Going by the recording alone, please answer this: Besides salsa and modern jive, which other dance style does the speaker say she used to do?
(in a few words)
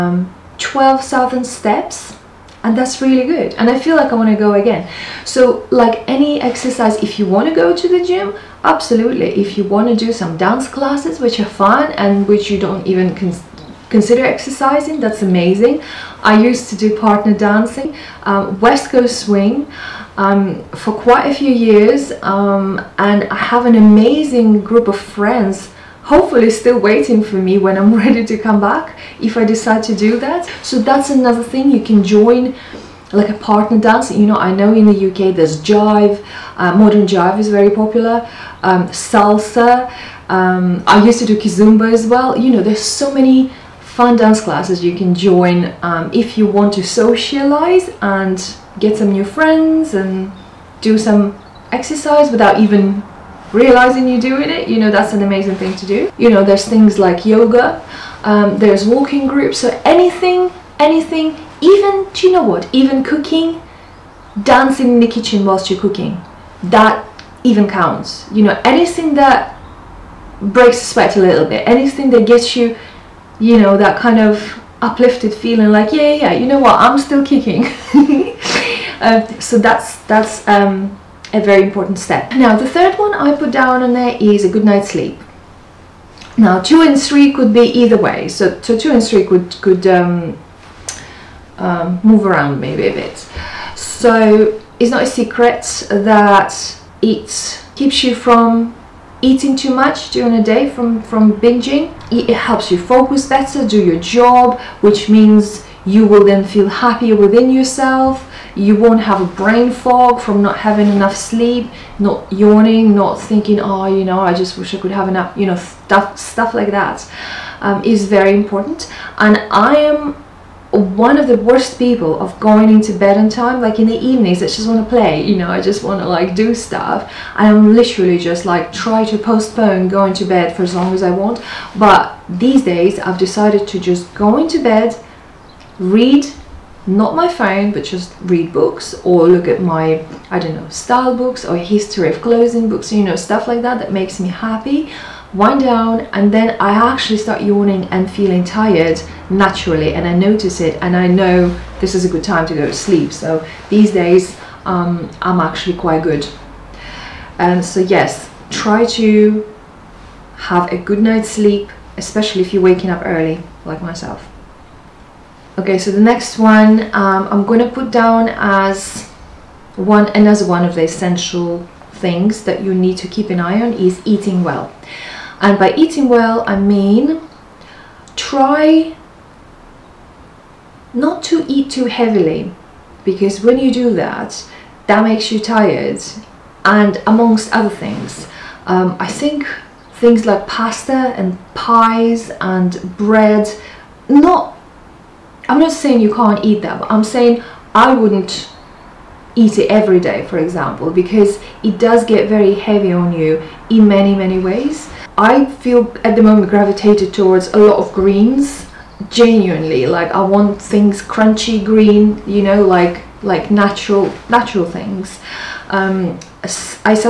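kizomba.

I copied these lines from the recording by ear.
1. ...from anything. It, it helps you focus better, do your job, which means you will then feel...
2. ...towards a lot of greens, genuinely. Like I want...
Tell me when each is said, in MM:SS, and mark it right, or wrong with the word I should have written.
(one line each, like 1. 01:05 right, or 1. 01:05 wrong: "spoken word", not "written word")
1. 01:41 wrong: "binging", not "anything"
2. 03:27 right.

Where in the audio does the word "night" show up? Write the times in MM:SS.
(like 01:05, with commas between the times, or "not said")
01:24, 02:41.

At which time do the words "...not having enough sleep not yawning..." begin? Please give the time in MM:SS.
01:50.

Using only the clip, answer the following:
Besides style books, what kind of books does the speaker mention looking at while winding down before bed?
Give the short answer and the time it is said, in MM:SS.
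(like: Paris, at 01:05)
history of clothing, at 02:21.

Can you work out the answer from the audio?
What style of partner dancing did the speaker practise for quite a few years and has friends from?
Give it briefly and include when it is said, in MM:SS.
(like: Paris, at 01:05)
West Coast swing, at 00:18.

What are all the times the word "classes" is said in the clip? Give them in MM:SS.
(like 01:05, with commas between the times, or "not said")
00:10, 00:44.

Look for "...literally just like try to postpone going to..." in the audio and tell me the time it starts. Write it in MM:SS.
02:07.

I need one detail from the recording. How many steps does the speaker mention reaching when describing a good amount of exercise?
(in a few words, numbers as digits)
12,000.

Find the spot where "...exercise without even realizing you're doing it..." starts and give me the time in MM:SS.
00:51.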